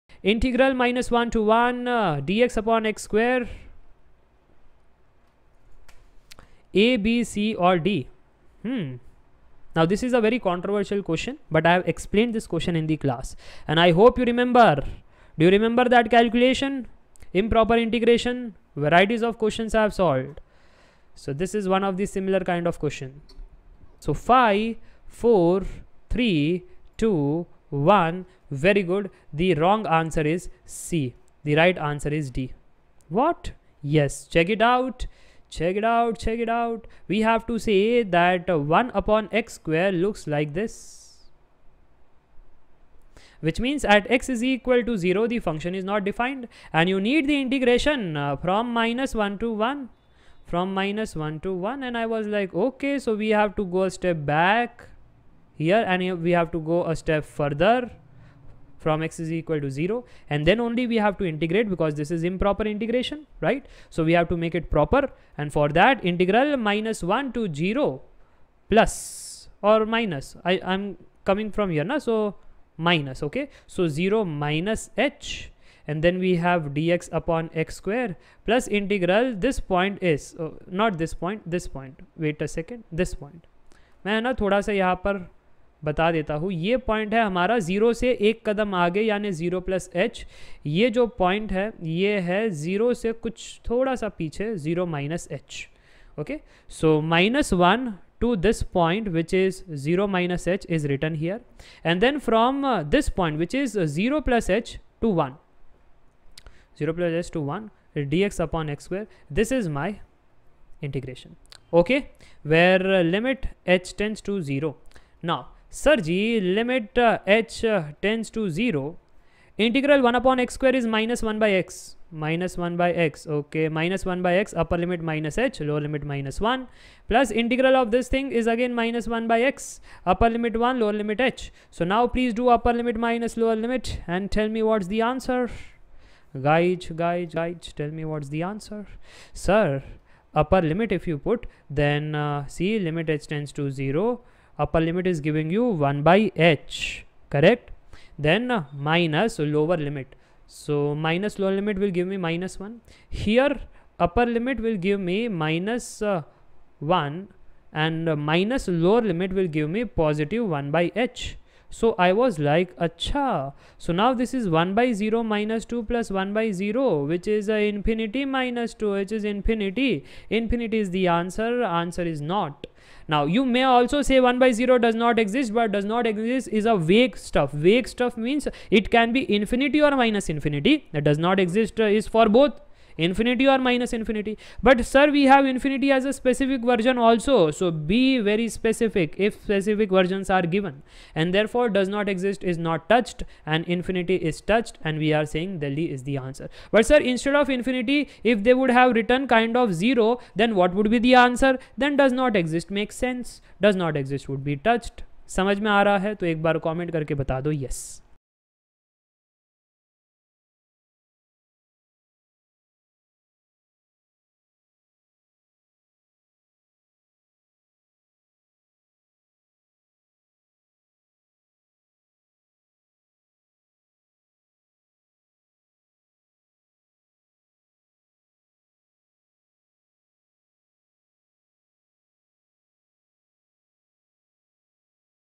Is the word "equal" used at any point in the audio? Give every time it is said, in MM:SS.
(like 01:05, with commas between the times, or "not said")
00:44, 00:59.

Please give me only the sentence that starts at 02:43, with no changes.
So now this is 1 by 0 minus 2 plus 1 by 0, which is uh, infinity minus 2, which is infinity.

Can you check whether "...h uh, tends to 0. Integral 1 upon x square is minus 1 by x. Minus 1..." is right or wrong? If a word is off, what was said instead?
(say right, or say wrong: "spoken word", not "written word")
right.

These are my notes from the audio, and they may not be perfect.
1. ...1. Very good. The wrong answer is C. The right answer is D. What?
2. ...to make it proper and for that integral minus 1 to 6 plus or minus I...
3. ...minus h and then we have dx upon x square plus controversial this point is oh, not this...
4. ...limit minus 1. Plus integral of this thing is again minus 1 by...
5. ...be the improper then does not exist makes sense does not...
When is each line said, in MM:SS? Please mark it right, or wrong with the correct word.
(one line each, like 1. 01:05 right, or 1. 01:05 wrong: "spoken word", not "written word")
1. 00:27 right
2. 01:04 wrong: "0", not "6"
3. 01:14 wrong: "integral", not "controversial"
4. 02:05 right
5. 03:20 wrong: "answer", not "improper".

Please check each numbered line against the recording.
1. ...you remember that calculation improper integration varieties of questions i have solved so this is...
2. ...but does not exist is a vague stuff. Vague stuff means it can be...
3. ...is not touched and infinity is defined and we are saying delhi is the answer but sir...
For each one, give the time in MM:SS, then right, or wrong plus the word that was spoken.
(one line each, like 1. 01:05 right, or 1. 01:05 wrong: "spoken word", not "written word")
1. 00:15 right
2. 02:55 right
3. 03:12 wrong: "touched", not "defined".